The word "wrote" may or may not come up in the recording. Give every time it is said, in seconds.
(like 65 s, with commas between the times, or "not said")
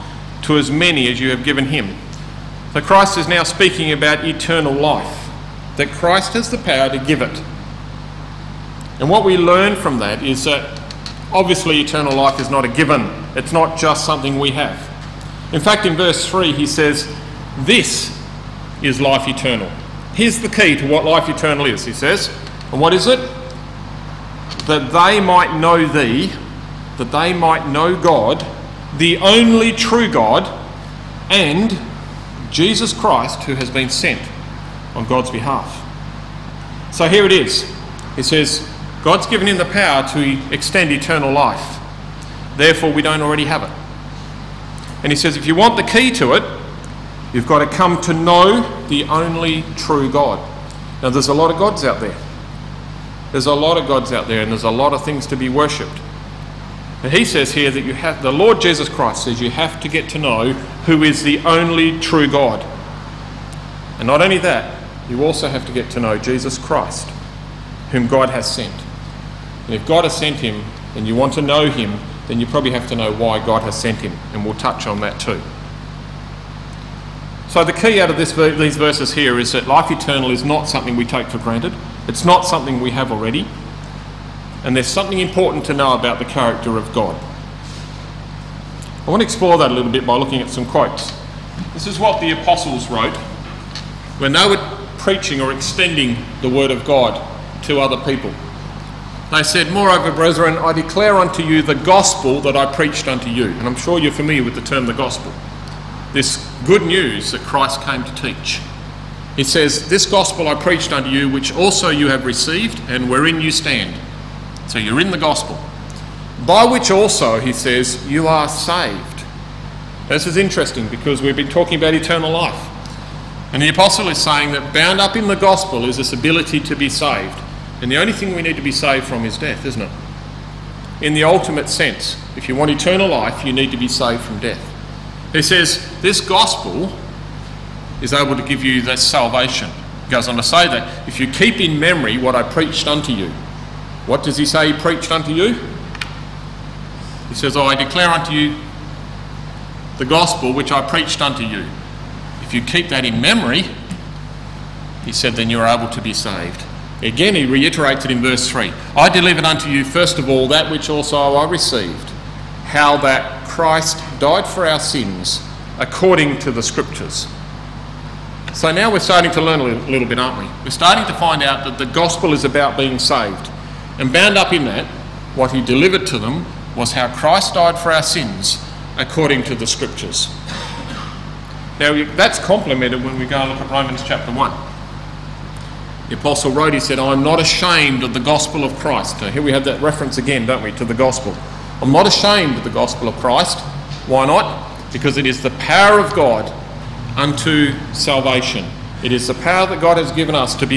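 92 s, 186 s.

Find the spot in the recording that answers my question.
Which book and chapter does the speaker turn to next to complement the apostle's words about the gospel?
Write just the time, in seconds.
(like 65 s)
183 s.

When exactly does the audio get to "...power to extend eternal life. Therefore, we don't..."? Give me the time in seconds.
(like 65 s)
39 s.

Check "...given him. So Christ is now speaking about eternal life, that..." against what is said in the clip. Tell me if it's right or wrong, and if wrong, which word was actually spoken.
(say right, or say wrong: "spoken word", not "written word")
right.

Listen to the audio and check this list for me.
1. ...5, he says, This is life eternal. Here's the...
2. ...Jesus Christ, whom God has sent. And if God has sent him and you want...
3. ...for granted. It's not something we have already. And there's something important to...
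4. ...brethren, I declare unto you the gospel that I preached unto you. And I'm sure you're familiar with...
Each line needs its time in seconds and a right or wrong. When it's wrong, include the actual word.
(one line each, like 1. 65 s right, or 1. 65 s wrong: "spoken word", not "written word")
1. 16 s wrong: "3", not "5"
2. 66 s right
3. 81 s right
4. 100 s right.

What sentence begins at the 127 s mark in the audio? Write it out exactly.
And the only thing we need to be saved from is death, isn't it?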